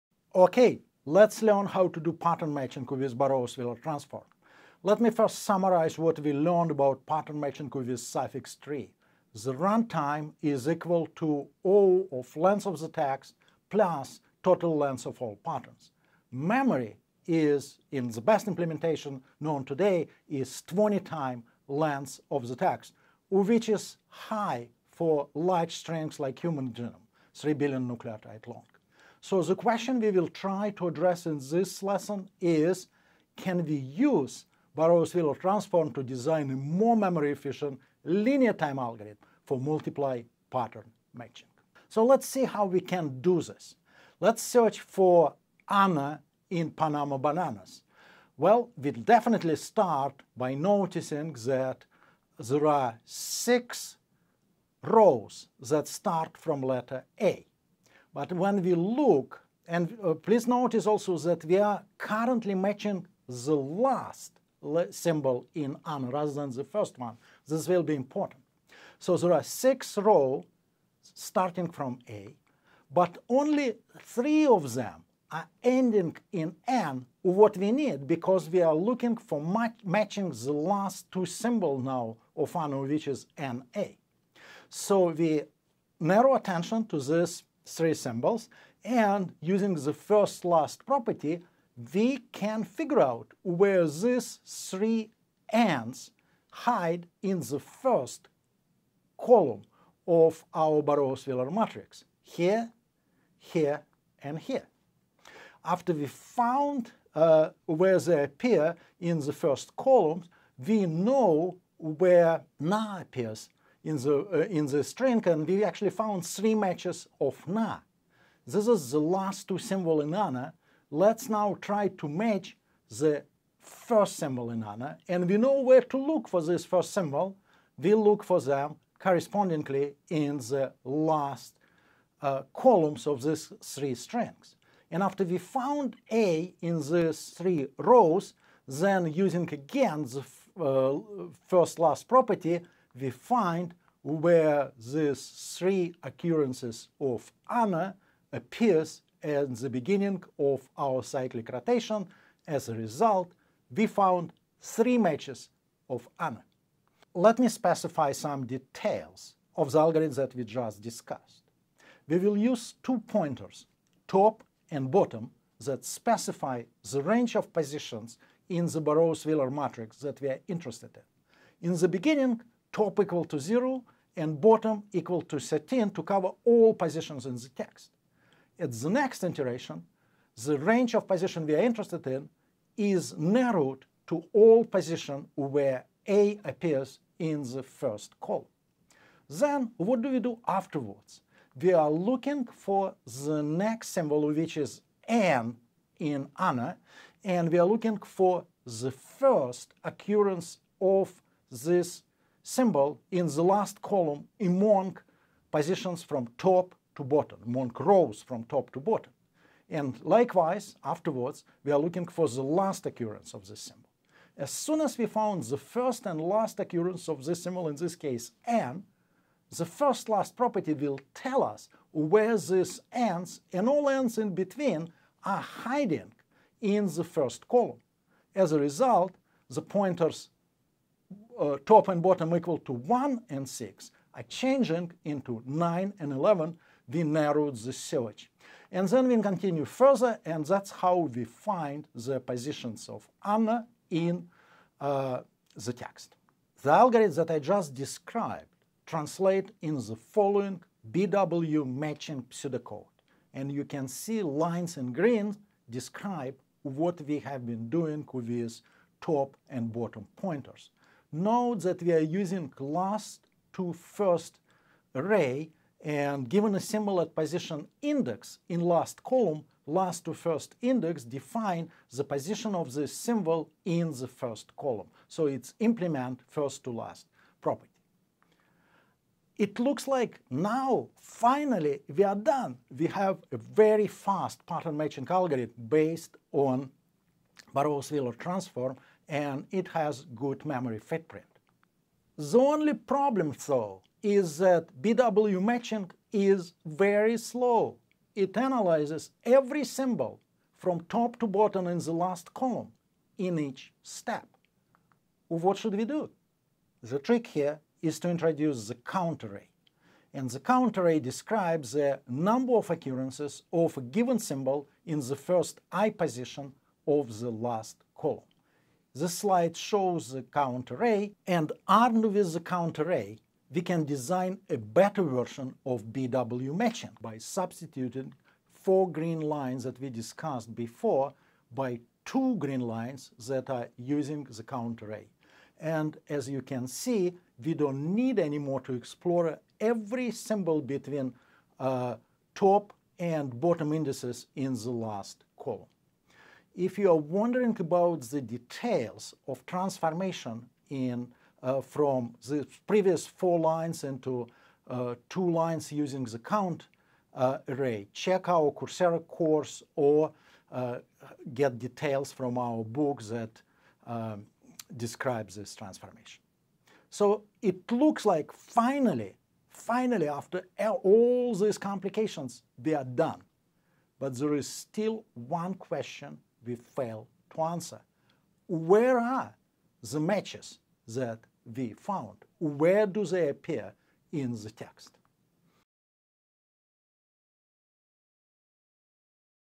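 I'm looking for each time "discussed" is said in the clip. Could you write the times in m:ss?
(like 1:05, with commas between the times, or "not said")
2:40, 5:29.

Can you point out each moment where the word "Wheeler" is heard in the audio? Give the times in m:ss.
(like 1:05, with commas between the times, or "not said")
0:03, 0:35, 1:40, 2:48, 4:47.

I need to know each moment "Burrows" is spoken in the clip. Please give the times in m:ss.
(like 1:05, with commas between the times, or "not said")
0:03, 0:34, 1:40, 2:48, 4:47.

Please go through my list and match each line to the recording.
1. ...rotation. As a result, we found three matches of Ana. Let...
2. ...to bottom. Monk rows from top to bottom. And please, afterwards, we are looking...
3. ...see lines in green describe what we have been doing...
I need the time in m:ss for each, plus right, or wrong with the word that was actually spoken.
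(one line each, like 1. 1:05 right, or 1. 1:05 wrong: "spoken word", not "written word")
1. 2:31 right
2. 3:26 wrong: "likewise", not "please"
3. 4:13 right.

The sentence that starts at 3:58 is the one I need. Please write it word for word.
And then we continue further, and that's how we find the positions of Anna in uh, the text.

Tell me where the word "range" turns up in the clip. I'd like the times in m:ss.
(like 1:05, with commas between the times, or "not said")
2:47, 3:00.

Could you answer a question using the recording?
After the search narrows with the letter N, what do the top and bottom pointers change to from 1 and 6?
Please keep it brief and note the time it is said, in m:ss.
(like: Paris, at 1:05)
9 and 11, at 3:55.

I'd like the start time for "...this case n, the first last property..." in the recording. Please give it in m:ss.
3:37.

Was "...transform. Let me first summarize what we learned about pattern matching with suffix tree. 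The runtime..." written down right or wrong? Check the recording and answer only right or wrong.
right.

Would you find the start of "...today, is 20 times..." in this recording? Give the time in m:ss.
0:19.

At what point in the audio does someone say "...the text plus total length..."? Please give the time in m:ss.
0:12.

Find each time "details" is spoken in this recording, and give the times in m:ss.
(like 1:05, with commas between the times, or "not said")
2:38, 5:48, 6:01.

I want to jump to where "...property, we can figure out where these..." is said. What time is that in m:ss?
1:30.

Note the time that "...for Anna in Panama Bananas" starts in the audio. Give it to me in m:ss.
0:44.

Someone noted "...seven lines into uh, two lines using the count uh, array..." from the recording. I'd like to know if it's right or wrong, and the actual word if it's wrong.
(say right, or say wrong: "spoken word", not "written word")
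wrong: "four", not "seven".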